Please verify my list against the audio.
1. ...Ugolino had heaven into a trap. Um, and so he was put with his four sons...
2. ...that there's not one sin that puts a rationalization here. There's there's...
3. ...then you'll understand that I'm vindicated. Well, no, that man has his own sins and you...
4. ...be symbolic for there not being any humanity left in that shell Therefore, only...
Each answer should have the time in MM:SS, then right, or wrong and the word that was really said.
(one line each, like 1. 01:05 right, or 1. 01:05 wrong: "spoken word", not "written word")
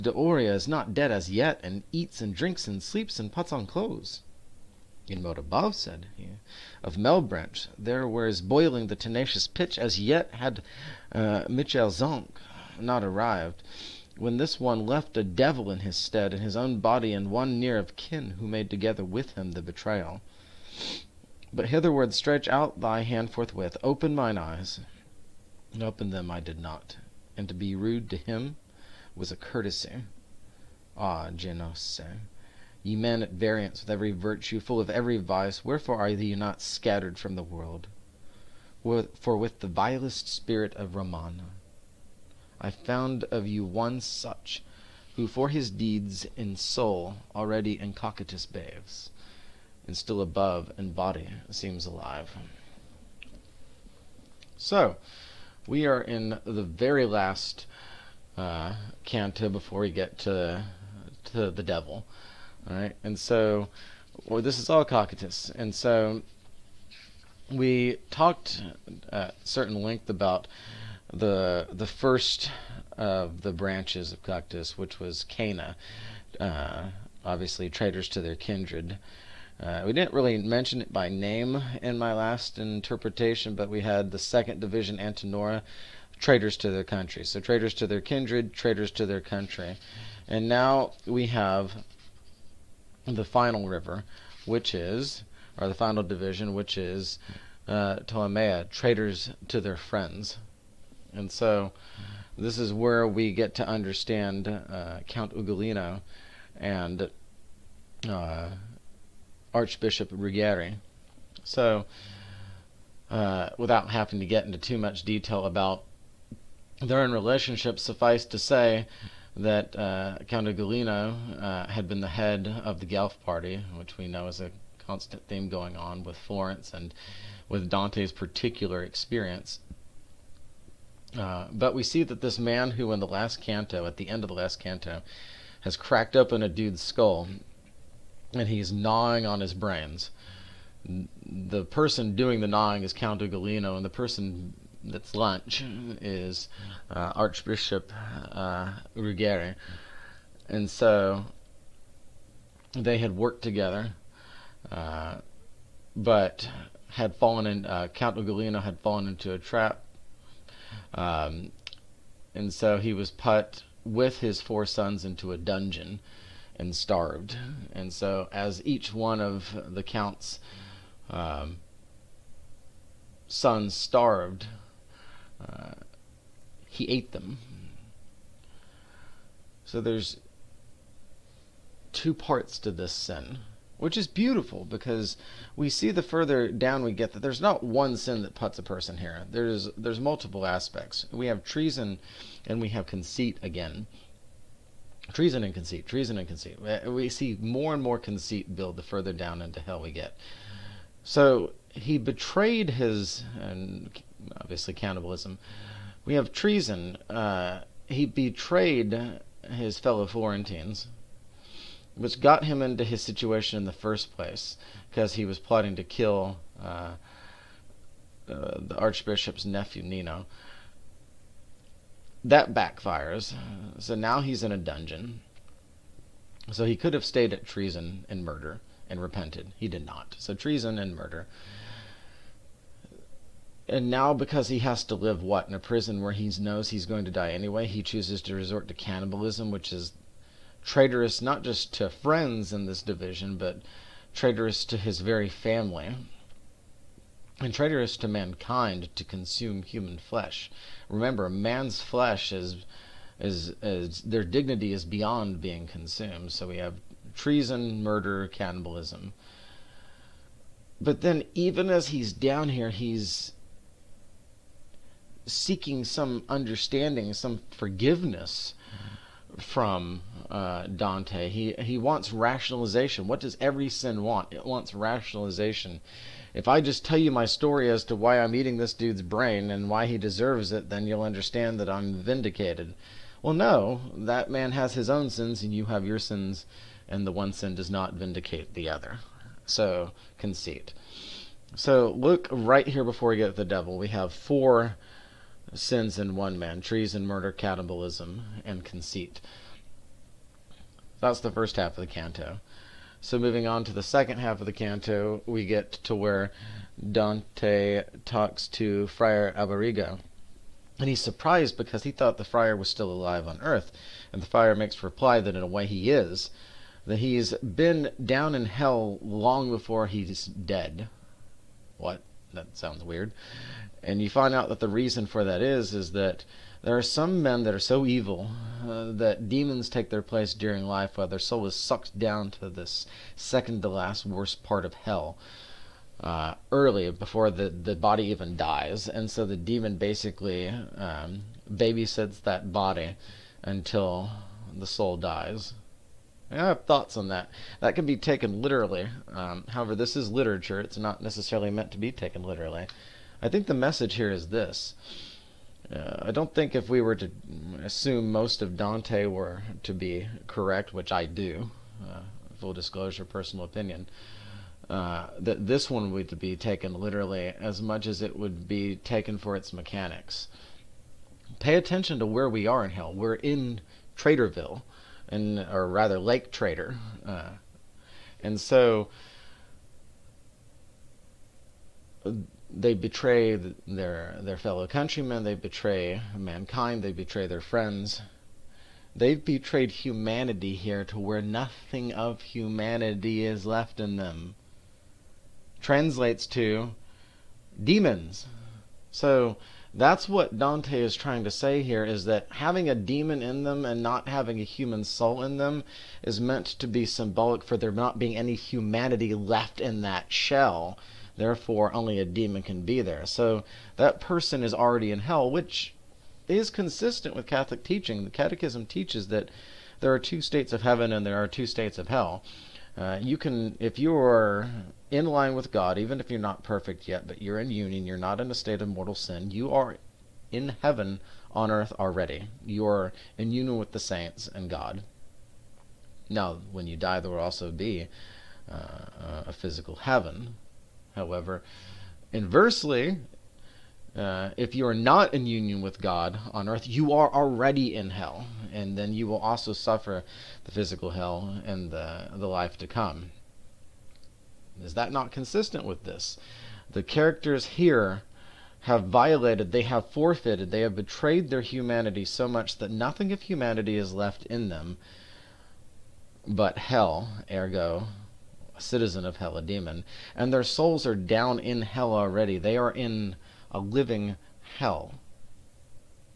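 1. 02:38 wrong: "fallen", not "heaven"
2. 03:07 wrong: "person", not "rationalization"
3. 04:40 right
4. 06:46 right.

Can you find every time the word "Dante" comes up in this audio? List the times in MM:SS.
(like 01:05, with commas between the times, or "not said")
02:07, 04:30, 05:06, 05:58, 06:40.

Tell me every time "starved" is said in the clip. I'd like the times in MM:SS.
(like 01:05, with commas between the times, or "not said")
02:46, 02:53.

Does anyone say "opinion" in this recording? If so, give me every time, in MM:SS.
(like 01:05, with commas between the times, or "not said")
06:03.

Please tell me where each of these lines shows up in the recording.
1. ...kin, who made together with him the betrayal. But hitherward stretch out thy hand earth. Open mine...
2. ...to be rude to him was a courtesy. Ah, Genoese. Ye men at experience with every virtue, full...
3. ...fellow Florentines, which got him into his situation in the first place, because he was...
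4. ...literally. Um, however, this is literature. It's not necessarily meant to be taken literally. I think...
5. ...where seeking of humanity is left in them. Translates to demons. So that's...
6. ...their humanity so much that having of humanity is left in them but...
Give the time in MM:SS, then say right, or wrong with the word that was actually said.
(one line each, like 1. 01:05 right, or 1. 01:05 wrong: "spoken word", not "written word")
1. 00:17 wrong: "forthwith", not "earth"
2. 00:27 wrong: "variance", not "experience"
3. 03:29 right
4. 05:48 right
5. 06:30 wrong: "nothing", not "seeking"
6. 07:41 wrong: "nothing", not "having".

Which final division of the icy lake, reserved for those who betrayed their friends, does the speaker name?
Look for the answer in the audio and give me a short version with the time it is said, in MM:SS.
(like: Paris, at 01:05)
Ptolemaea, at 01:38.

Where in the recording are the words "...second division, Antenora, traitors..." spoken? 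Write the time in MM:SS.
01:24.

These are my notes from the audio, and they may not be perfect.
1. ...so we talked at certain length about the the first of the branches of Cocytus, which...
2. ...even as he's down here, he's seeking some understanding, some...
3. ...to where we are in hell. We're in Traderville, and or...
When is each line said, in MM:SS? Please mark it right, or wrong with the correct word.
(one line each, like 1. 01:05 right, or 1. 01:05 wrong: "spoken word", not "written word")
1. 01:05 right
2. 04:21 right
3. 06:11 right.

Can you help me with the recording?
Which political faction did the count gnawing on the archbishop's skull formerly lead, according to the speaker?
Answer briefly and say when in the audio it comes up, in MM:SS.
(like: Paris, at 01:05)
Guelph Party, at 02:02.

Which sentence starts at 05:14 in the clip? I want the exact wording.
And the friar makes reply that in a way he is, that he's been down in hell long before he's dead.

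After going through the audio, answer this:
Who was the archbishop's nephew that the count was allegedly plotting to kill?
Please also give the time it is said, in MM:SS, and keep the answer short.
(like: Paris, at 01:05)
Nino, at 03:39.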